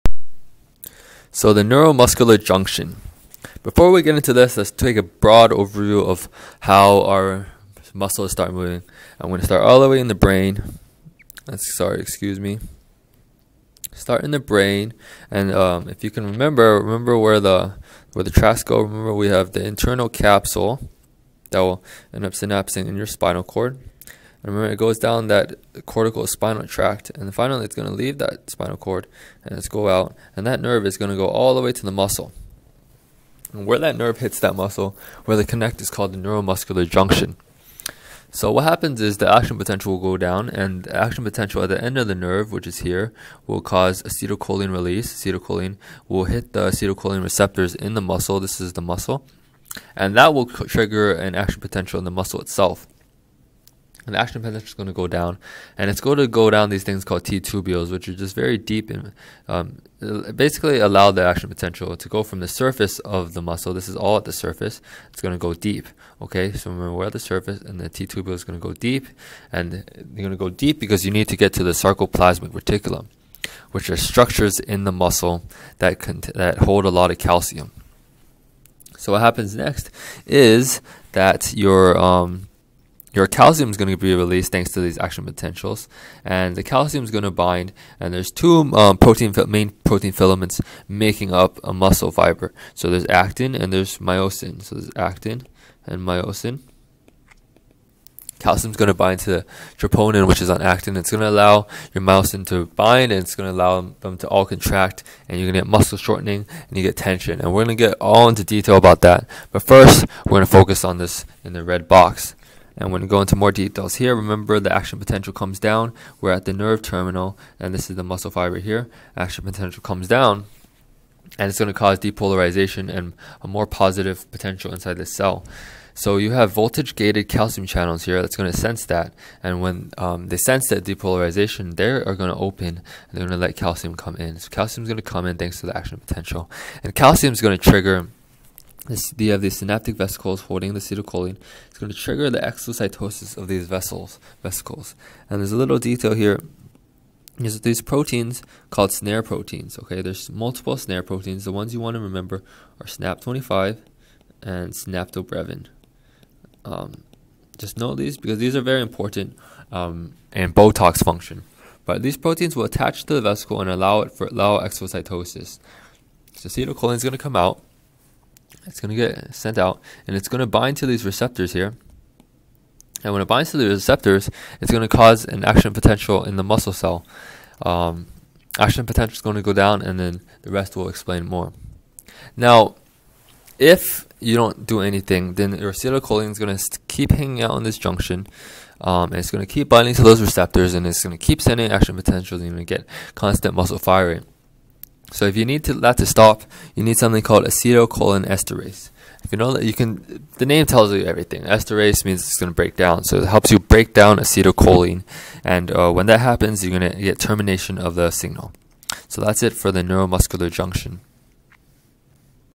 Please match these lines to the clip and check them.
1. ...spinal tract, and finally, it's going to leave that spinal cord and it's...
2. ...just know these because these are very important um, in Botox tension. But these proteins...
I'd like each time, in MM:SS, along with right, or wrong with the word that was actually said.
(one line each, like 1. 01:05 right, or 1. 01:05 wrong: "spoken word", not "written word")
1. 00:26 right
2. 02:37 wrong: "function", not "tension".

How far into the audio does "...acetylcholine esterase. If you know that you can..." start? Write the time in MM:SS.
03:17.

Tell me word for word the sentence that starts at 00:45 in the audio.
Acetylcholine will hit the acetylcholine receptors in the muscle.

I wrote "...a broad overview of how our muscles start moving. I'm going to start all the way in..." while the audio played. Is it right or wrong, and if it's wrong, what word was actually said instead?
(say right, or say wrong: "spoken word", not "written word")
right.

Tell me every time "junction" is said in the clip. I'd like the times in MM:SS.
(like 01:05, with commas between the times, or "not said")
00:02, 00:36, 03:07, 03:30.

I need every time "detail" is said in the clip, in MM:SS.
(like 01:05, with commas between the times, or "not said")
01:48, 01:53, 02:25.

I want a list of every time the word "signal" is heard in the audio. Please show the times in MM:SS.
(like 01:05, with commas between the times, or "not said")
03:28.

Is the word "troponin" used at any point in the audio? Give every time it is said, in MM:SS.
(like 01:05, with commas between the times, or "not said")
01:39.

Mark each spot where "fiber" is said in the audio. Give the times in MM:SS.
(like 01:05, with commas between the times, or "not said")
01:32, 01:58.